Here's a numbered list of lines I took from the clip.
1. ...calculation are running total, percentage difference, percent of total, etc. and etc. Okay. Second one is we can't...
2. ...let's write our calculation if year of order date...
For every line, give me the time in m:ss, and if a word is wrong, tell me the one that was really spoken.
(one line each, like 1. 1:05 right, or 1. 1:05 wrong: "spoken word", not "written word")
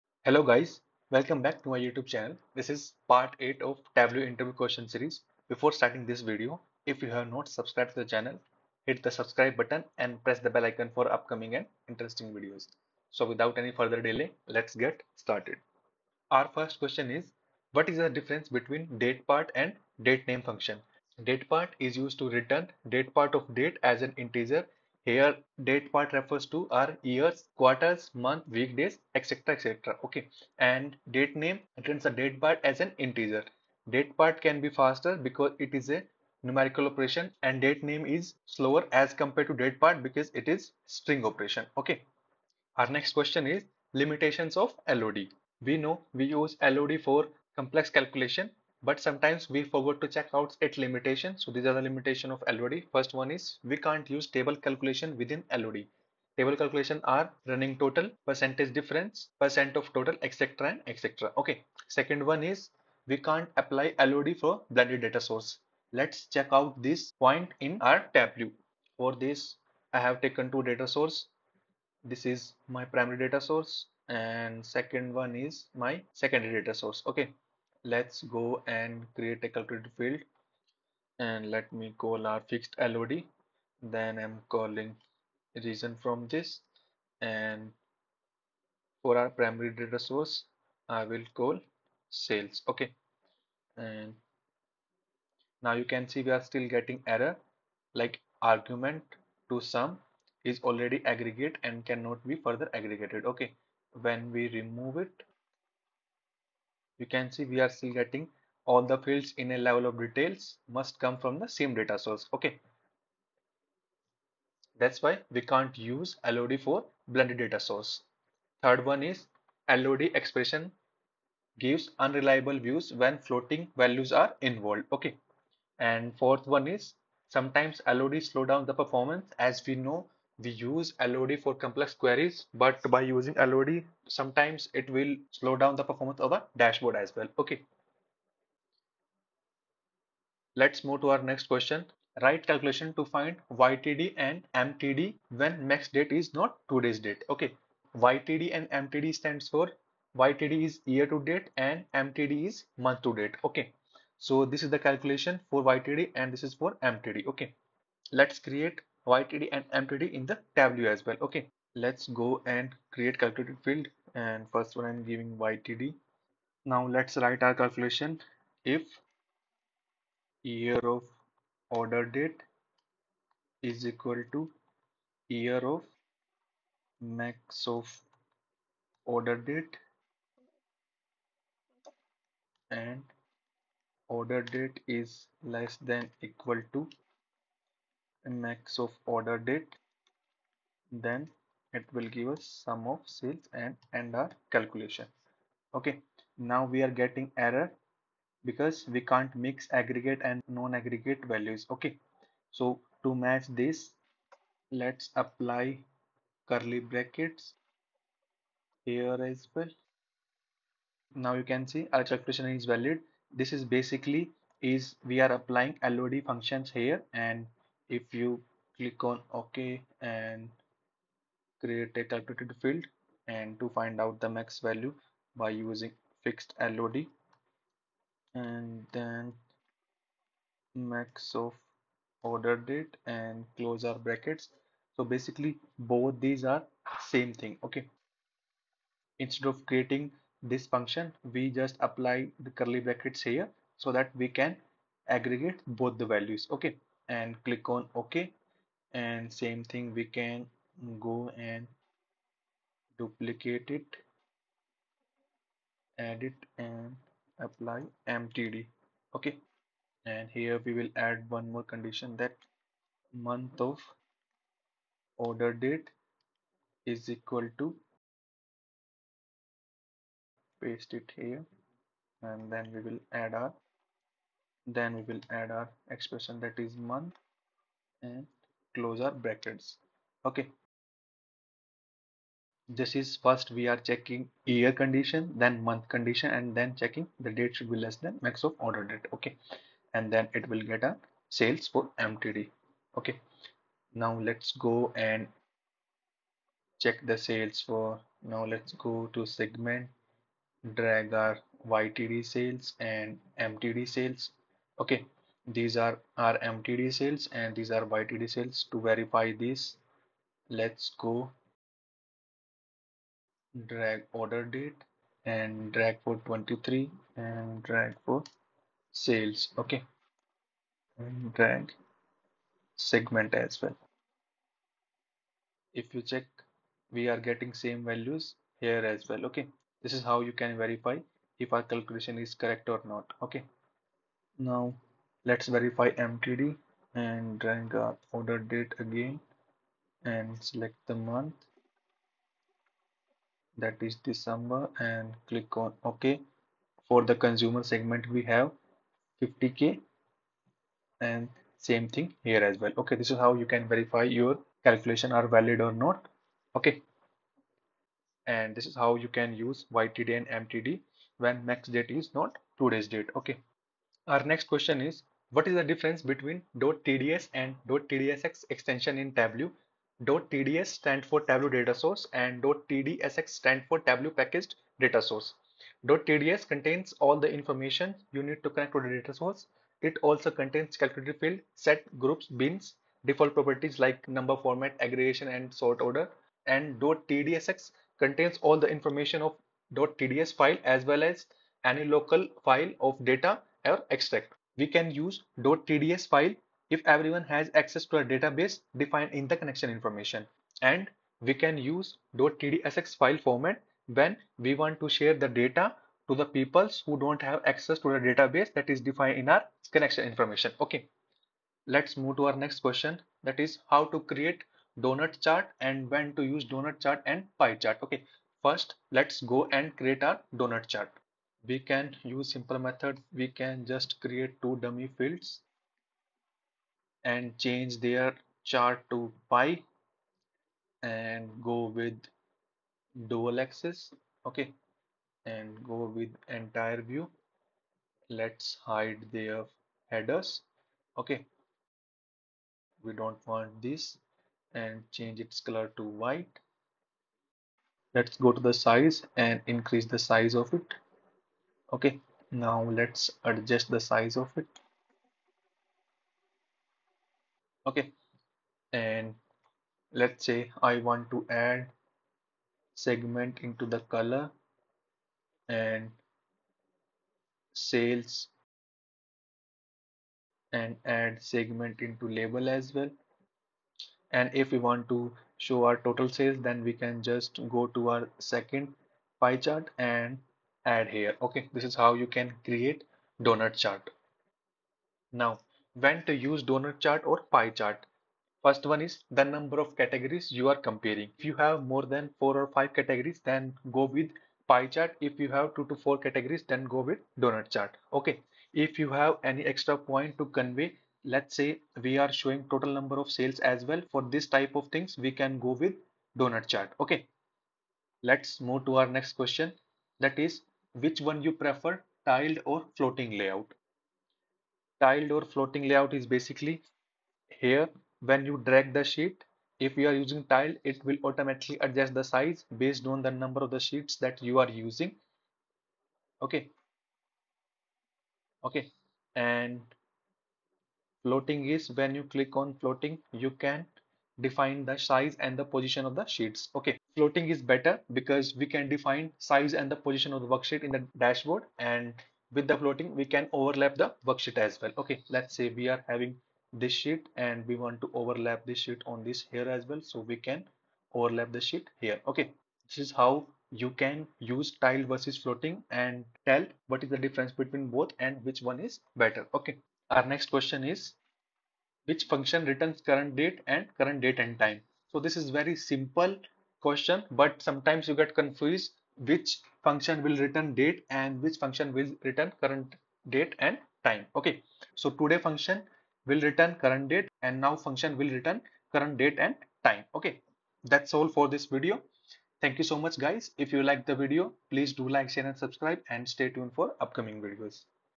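1. 0:56 right
2. 2:46 right.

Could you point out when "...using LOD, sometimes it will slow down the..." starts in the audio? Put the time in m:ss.
2:13.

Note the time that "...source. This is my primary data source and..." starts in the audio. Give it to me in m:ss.
1:10.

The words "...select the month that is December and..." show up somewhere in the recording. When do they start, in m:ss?
5:40.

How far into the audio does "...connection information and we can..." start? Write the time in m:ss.
6:39.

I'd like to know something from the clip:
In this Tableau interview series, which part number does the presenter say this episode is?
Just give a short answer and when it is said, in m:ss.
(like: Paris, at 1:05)
8, at 0:03.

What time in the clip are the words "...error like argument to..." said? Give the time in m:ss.
1:37.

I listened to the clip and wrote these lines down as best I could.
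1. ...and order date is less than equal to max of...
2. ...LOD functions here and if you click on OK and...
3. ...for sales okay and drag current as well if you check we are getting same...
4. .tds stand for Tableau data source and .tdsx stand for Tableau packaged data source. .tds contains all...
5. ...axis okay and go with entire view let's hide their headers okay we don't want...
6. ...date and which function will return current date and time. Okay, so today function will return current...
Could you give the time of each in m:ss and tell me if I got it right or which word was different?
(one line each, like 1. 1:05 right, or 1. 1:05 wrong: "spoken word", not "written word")
1. 3:02 right
2. 3:35 right
3. 5:18 wrong: "segment", not "current"
4. 6:10 right
5. 7:13 right
6. 9:30 right.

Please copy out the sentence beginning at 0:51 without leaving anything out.
So these are the limitation of LOD.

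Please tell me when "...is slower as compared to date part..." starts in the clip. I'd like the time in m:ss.
0:38.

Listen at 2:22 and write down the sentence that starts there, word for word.
Write calculation to find YTD and MTD when max date is not today's date.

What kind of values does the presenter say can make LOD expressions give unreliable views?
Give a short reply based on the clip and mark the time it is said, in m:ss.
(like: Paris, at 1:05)
floating values, at 2:03.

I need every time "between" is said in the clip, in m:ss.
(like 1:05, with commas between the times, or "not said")
0:18, 6:06, 9:17.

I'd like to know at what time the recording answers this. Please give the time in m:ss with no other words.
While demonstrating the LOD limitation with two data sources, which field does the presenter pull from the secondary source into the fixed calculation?
1:25.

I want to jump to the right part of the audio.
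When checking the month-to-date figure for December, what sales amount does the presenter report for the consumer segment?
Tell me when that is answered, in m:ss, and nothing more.
5:49.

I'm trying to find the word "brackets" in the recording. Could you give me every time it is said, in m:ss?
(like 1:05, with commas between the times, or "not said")
3:26, 3:53, 4:02, 4:39.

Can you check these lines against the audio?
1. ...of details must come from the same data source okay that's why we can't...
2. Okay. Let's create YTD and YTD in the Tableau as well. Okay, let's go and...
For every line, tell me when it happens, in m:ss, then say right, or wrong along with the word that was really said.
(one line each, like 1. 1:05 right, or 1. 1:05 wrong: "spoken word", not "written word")
1. 1:49 right
2. 2:37 wrong: "MTD", not "YTD".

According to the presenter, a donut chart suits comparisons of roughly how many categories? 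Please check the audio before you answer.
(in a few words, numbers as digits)
2 to 4.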